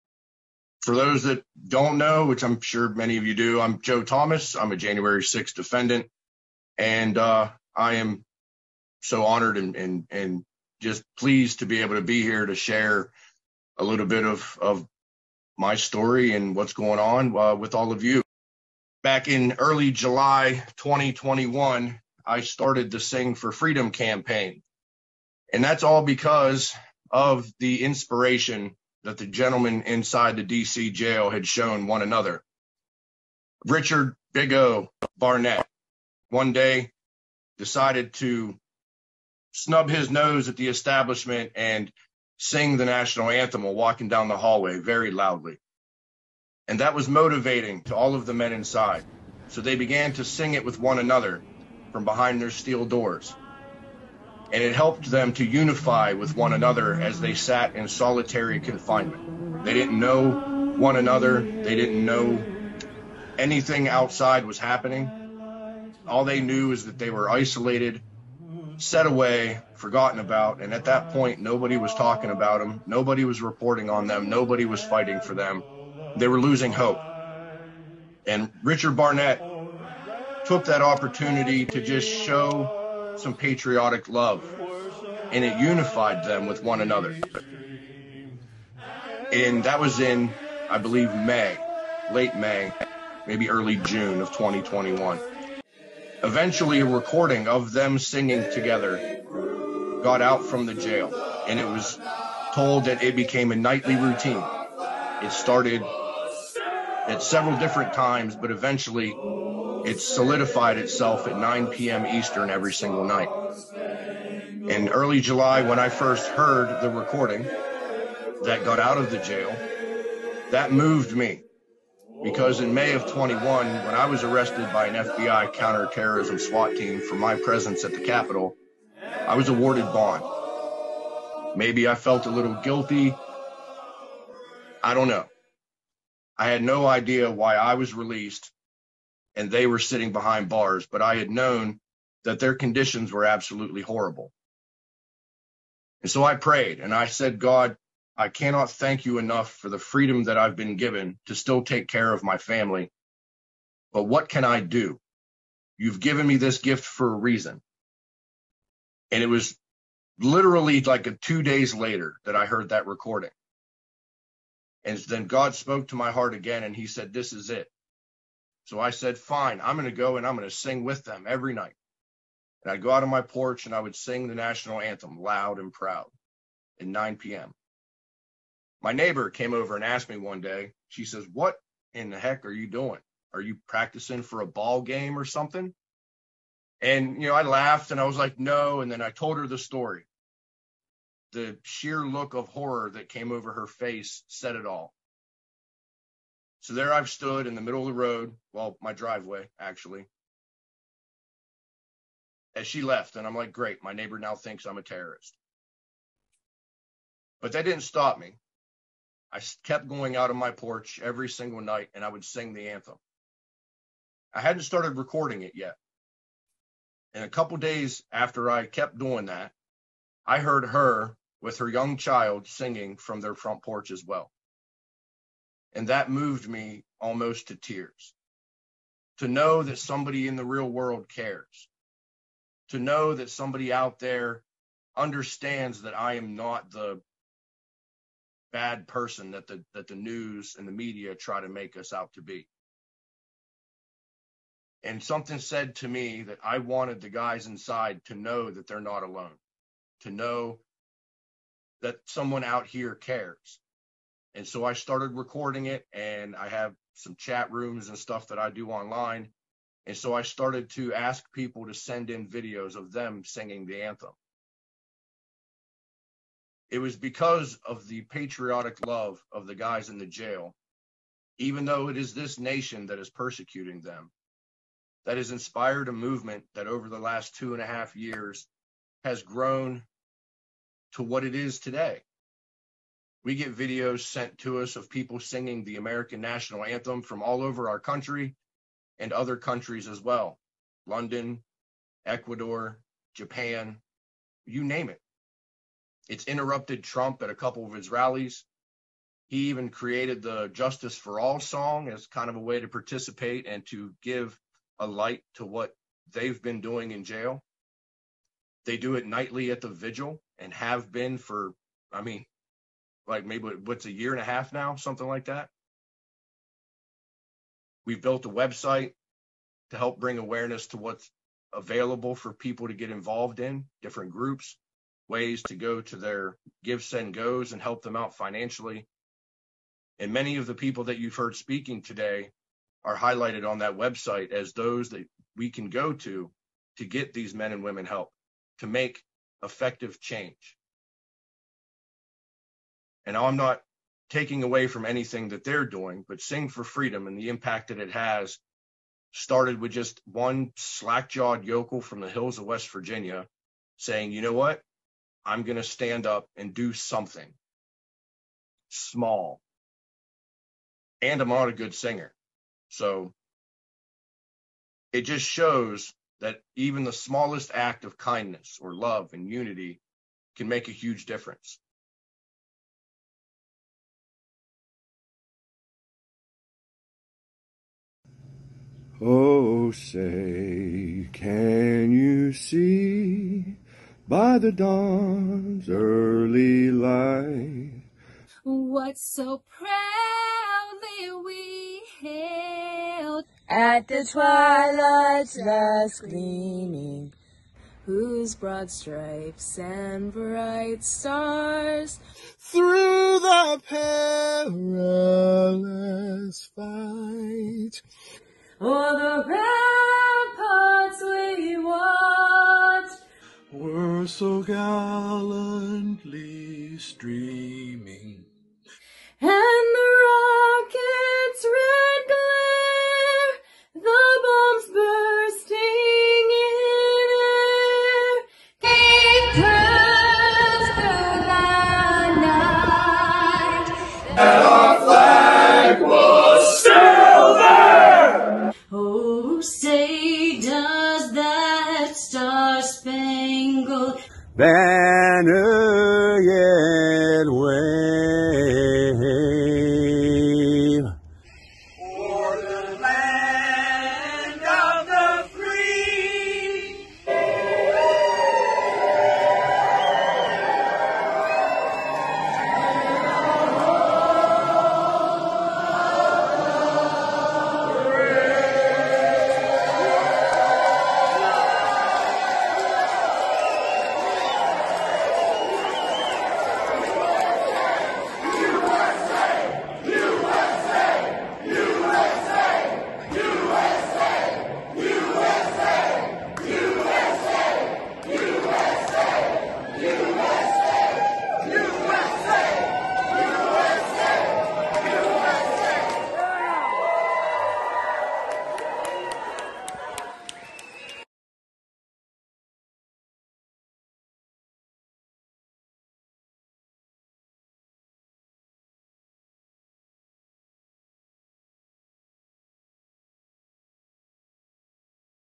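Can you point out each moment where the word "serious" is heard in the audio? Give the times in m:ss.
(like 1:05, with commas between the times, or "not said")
not said.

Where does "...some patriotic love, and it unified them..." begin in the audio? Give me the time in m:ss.
1:23.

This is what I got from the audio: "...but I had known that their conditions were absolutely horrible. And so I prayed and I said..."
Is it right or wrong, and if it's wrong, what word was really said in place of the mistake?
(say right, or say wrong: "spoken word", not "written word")
right.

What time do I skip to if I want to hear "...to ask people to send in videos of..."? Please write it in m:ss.
4:20.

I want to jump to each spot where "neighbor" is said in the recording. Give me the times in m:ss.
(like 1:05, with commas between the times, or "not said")
2:58, 3:23.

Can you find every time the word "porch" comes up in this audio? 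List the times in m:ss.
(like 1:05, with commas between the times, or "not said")
2:53, 3:30, 3:43.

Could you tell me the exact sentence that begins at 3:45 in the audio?
And that moved me almost to tears.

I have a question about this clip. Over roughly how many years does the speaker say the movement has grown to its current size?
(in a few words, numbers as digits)
2 and a half years.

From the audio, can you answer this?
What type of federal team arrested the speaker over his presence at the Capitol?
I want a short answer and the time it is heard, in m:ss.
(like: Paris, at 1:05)
FBI counterterrorism SWAT team, at 2:05.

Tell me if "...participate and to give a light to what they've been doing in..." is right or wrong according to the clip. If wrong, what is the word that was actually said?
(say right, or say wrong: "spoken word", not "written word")
right.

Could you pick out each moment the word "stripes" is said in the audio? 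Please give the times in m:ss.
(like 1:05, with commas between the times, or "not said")
6:38.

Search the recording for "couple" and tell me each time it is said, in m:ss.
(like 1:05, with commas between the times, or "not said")
3:37, 4:57.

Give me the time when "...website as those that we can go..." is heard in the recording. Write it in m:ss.
5:33.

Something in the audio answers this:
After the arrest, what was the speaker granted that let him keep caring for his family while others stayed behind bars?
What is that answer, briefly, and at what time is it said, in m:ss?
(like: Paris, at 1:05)
bond, at 2:09.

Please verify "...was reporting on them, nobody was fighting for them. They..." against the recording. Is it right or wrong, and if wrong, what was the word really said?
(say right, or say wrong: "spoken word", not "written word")
right.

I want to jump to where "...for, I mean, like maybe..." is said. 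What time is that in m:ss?
5:11.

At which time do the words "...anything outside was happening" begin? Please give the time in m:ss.
1:03.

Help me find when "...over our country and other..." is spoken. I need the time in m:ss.
4:47.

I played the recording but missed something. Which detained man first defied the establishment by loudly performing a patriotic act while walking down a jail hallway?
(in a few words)
Richard Bigo Barnett.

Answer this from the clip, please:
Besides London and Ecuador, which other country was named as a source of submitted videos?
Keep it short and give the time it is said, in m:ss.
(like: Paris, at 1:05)
Japan, at 4:53.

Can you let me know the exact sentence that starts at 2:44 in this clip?
And then God spoke to my heart again and he said, This is it.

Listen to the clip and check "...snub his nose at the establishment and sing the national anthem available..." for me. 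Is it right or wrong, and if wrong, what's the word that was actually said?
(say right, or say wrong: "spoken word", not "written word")
wrong: "while", not "available".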